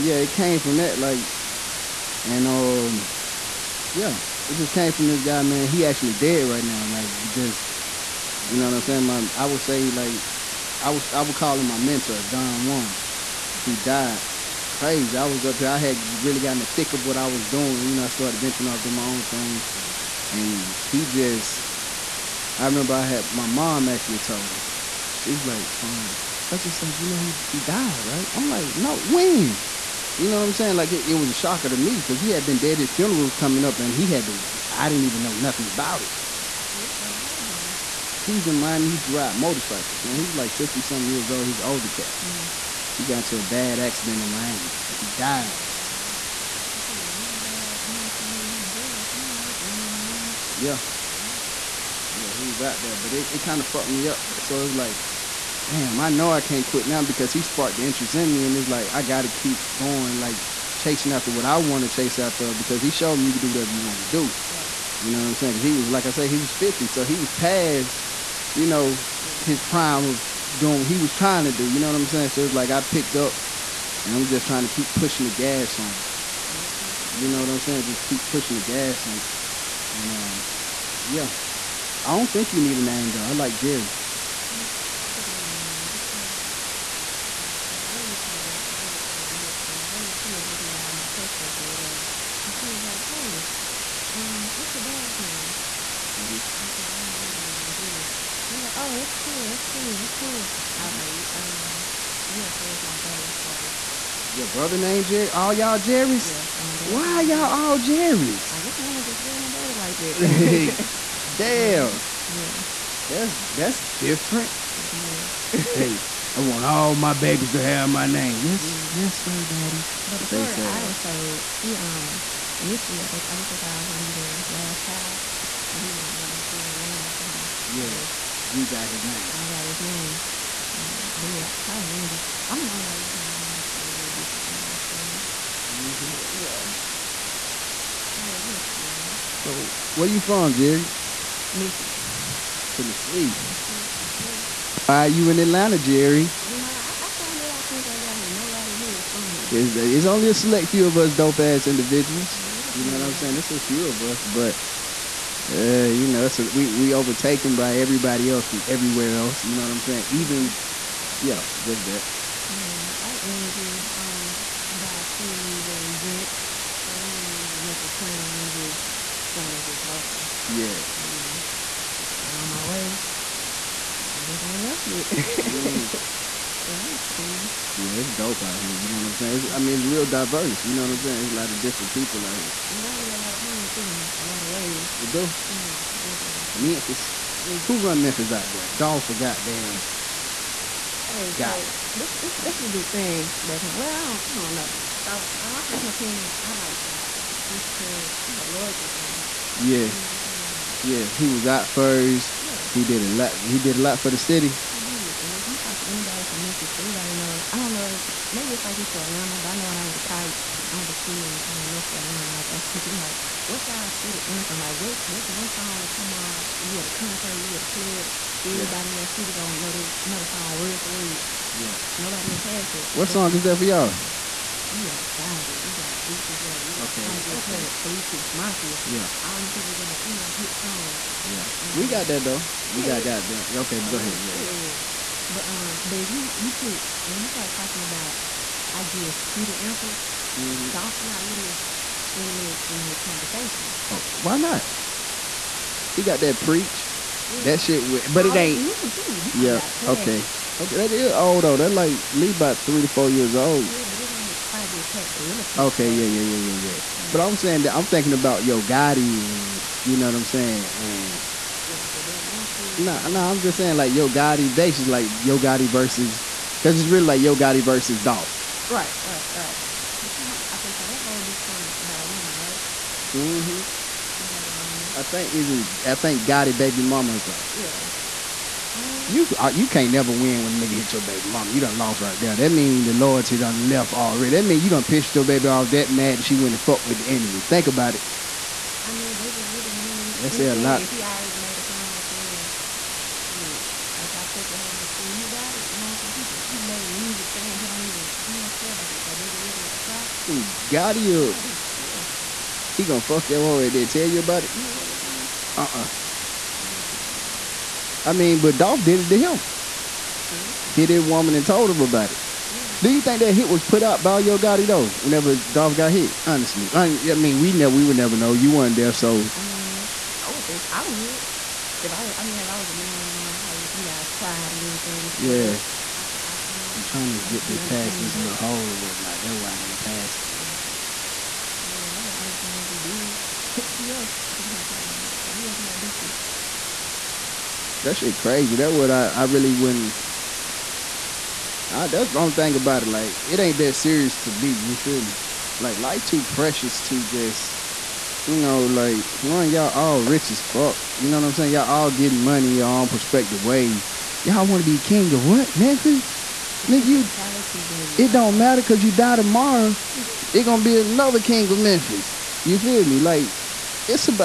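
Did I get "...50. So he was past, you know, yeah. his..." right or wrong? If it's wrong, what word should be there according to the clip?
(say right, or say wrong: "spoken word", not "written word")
right.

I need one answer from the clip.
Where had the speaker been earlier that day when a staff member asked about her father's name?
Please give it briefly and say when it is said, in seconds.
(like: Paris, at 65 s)
The bank, at 89 s.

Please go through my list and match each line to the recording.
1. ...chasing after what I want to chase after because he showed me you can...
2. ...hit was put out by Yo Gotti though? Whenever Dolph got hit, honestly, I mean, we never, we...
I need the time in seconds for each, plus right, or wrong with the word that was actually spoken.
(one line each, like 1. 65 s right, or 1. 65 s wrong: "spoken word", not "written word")
1. 60 s right
2. 313 s right.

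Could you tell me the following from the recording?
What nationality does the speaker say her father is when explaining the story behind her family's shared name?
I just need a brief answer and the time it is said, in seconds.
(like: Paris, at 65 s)
Nigerian, at 97 s.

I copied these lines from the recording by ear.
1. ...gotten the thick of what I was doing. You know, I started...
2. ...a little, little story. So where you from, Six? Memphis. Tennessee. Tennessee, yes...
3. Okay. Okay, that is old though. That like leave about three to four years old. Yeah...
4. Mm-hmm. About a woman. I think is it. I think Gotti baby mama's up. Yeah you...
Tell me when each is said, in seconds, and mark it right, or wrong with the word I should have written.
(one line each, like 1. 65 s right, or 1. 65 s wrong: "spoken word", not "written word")
1. 16 s right
2. 136 s wrong: "Jeri", not "Six"
3. 250 s right
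4. 273 s right.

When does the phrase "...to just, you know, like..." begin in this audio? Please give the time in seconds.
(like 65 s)
346 s.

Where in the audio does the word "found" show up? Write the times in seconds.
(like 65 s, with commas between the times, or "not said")
147 s, 172 s.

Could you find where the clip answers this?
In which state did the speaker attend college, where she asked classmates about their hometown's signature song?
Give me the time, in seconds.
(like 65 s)
211 s.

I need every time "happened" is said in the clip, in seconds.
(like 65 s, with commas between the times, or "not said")
37 s, 169 s.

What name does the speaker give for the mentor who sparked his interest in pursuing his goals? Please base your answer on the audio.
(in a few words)
Don Juan.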